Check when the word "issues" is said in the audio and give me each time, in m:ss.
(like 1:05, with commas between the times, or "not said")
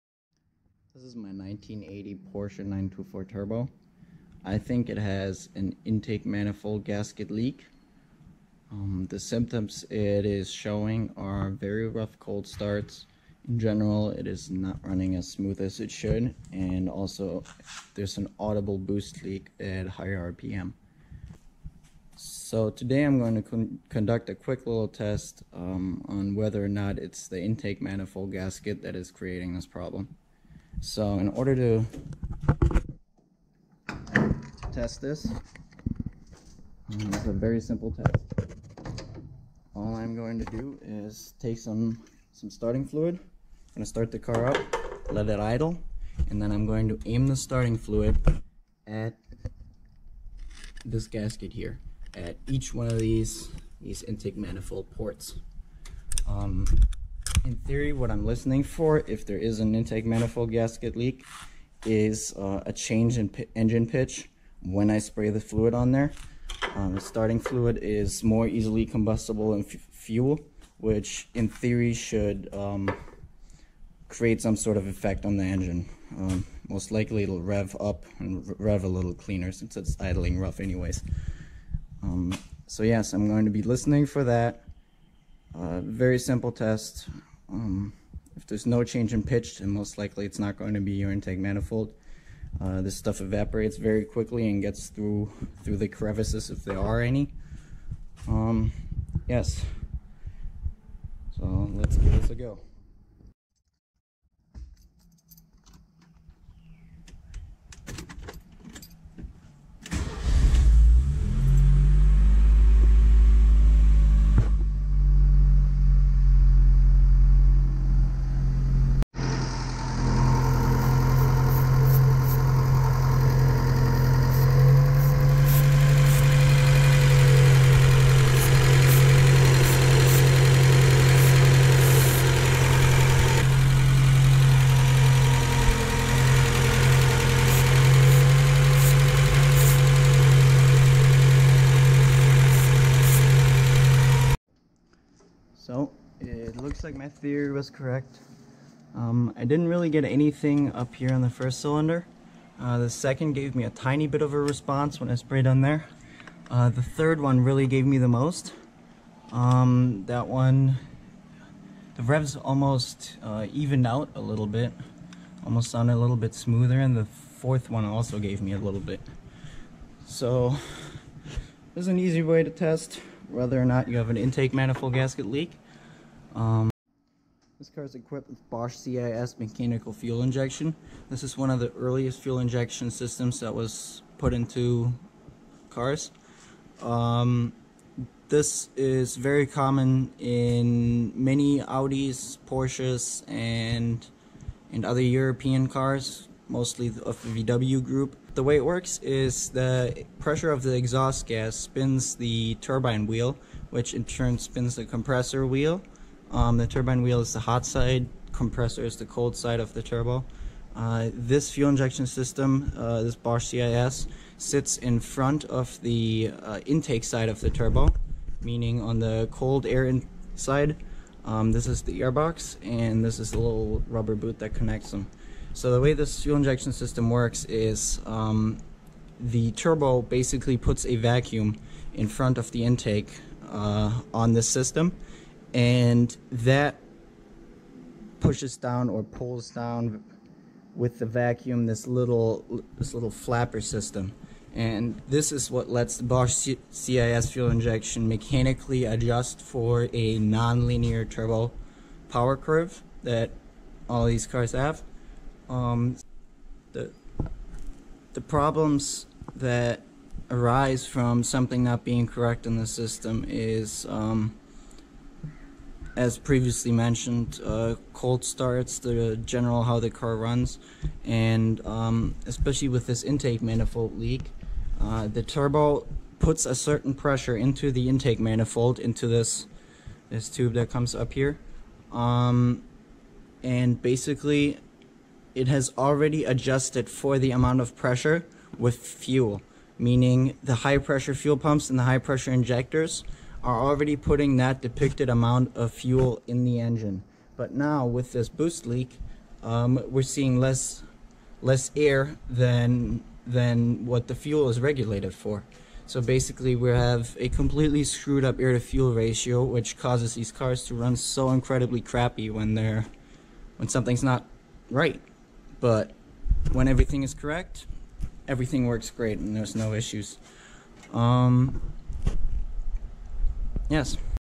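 5:19.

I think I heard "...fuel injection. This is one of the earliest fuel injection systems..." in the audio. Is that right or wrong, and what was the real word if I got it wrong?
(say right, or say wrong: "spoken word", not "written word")
right.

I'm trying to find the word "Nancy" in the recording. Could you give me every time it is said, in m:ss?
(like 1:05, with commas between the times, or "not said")
not said.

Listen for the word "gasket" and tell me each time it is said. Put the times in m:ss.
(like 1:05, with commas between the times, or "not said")
0:06, 0:28, 0:51, 1:00, 2:54.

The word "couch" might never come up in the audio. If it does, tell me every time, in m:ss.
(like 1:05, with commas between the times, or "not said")
not said.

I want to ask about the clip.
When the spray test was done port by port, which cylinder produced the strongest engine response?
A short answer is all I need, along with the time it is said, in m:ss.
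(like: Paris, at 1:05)
the third, at 2:36.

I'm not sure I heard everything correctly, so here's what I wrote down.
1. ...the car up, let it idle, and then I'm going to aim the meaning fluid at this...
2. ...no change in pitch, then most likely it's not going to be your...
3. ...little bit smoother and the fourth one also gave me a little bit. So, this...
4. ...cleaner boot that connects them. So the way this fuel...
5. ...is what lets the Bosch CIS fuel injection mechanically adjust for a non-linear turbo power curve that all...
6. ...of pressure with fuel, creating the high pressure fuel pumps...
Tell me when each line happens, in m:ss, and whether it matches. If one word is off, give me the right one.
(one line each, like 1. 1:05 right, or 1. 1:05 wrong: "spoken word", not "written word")
1. 0:44 wrong: "starting", not "meaning"
2. 1:28 right
3. 2:46 right
4. 3:43 wrong: "rubber", not "cleaner"
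5. 4:05 right
6. 4:47 wrong: "meaning", not "creating".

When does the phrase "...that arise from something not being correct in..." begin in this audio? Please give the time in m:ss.
4:19.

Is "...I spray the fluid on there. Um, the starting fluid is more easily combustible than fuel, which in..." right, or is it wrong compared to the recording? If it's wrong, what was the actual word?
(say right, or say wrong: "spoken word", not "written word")
right.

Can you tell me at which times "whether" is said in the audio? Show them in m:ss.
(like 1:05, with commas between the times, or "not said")
0:26, 2:53.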